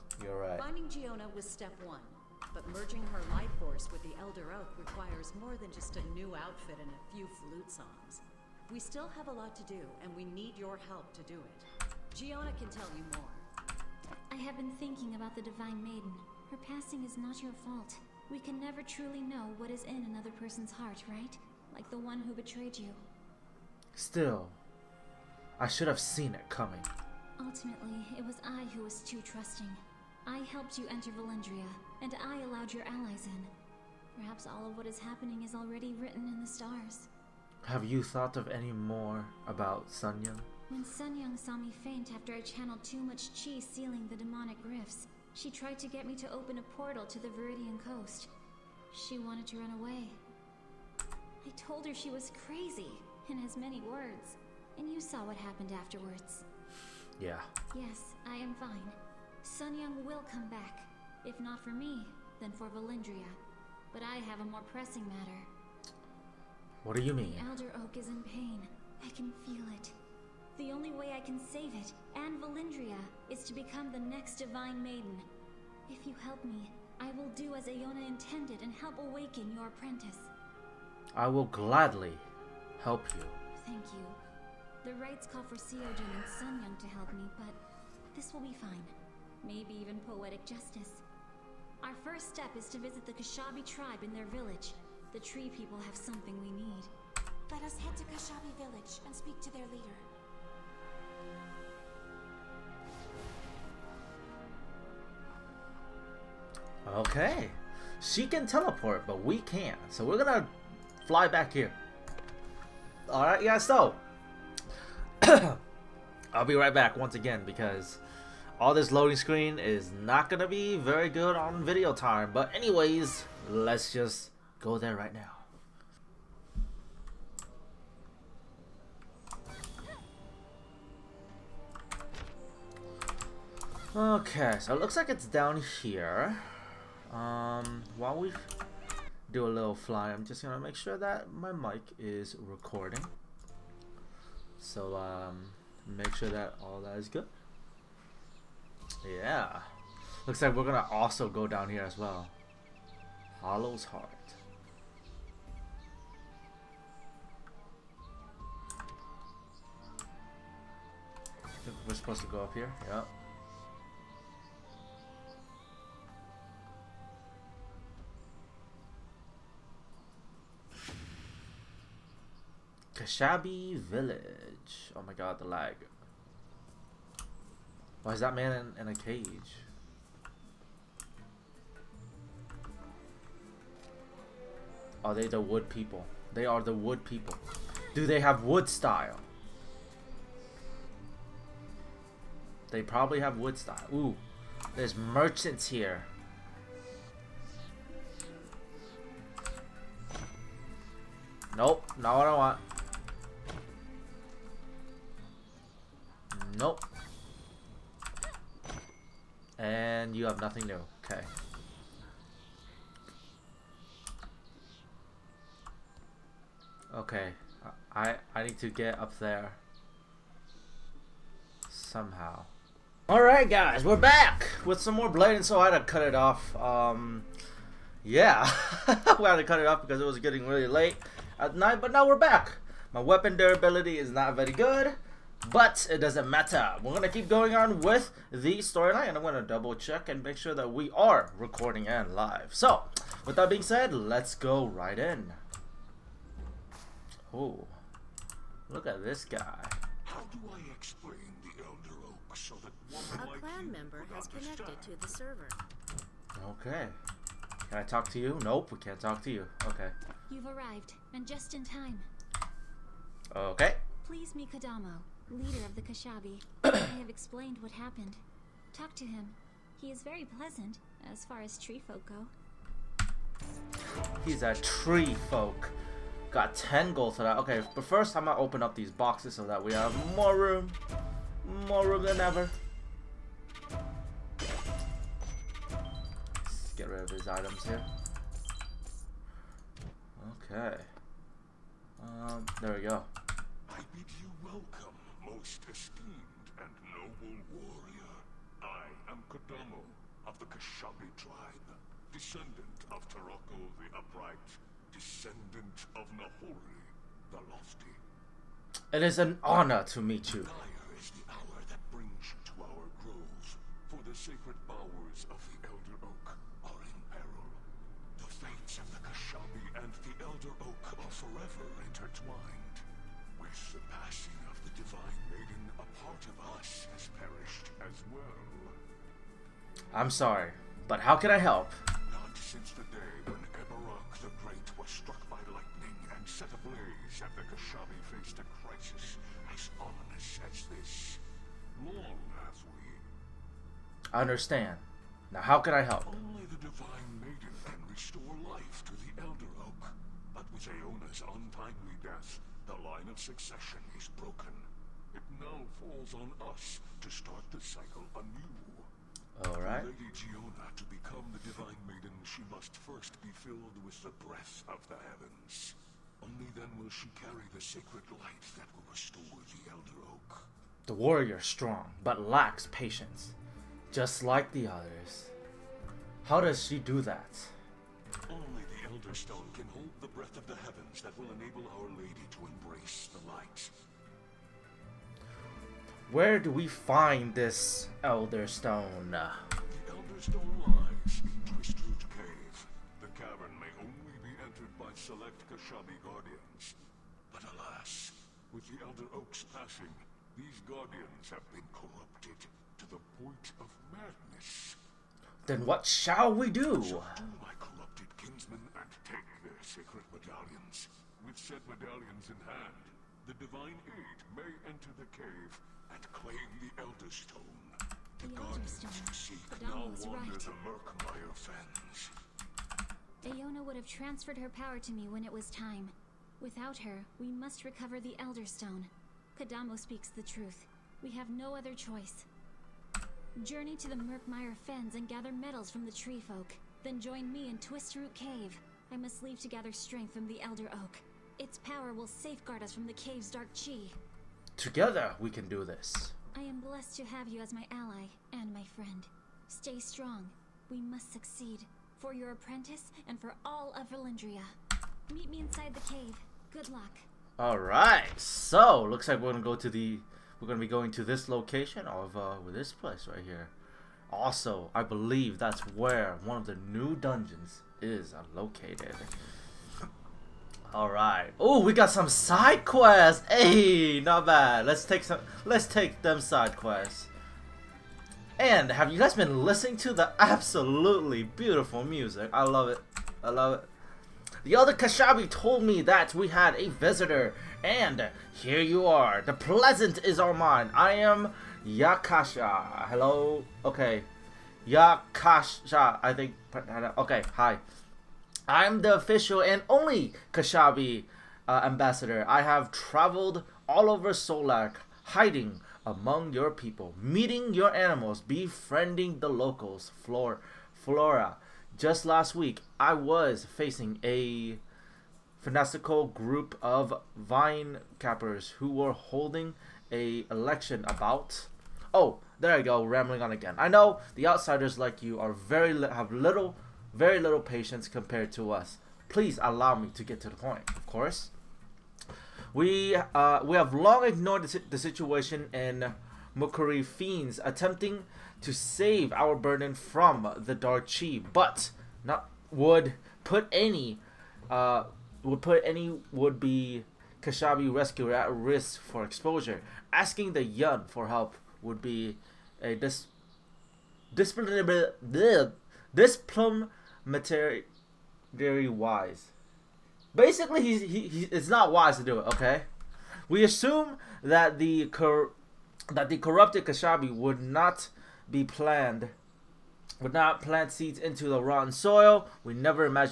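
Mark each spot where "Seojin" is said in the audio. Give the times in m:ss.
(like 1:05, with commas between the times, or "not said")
1:25.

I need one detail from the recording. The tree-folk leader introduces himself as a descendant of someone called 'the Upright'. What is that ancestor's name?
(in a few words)
Taroko.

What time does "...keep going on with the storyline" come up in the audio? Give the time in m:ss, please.
3:57.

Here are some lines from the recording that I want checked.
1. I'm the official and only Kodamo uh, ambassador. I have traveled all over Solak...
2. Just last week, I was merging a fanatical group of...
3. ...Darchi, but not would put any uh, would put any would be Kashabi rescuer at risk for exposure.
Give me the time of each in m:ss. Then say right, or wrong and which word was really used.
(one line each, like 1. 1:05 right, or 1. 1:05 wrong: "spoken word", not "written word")
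1. 8:18 wrong: "Kashabi", not "Kodamo"
2. 8:31 wrong: "facing", not "merging"
3. 9:00 right.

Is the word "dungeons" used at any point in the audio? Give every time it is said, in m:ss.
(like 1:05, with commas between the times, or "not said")
7:46.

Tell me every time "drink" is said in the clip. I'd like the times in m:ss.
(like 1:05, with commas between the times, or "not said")
not said.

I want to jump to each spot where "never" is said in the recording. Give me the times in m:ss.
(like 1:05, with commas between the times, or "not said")
0:18, 9:32.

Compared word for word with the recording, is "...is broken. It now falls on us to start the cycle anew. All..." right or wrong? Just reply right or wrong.
right.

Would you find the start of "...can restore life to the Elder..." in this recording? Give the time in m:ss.
5:47.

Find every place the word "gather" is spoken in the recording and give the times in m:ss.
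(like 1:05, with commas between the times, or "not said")
7:15, 7:19.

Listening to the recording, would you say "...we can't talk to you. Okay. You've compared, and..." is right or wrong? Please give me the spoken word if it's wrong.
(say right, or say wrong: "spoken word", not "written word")
wrong: "arrived", not "compared".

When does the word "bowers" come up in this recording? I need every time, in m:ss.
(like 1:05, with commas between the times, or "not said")
5:14.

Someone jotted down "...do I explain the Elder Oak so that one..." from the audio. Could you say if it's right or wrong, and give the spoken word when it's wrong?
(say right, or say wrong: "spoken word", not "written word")
right.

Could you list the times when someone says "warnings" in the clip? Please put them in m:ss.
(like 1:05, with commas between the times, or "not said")
not said.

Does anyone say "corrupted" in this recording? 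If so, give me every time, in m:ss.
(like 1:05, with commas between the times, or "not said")
6:41, 9:26.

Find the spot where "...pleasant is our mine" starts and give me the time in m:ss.
8:09.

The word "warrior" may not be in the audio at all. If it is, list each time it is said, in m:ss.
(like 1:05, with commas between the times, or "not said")
4:57, 6:10.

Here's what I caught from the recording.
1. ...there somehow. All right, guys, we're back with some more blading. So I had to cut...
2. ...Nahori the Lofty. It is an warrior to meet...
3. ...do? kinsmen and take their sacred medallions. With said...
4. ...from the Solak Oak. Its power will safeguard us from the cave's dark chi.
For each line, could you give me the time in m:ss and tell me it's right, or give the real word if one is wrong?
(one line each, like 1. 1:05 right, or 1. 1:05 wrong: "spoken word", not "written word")
1. 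3:39 right
2. 5:06 wrong: "honor", not "warrior"
3. 6:46 right
4. 7:20 wrong: "Elder", not "Solak".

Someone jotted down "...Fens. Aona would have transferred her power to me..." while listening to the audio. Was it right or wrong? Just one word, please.
right.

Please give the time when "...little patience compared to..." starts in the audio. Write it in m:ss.
8:47.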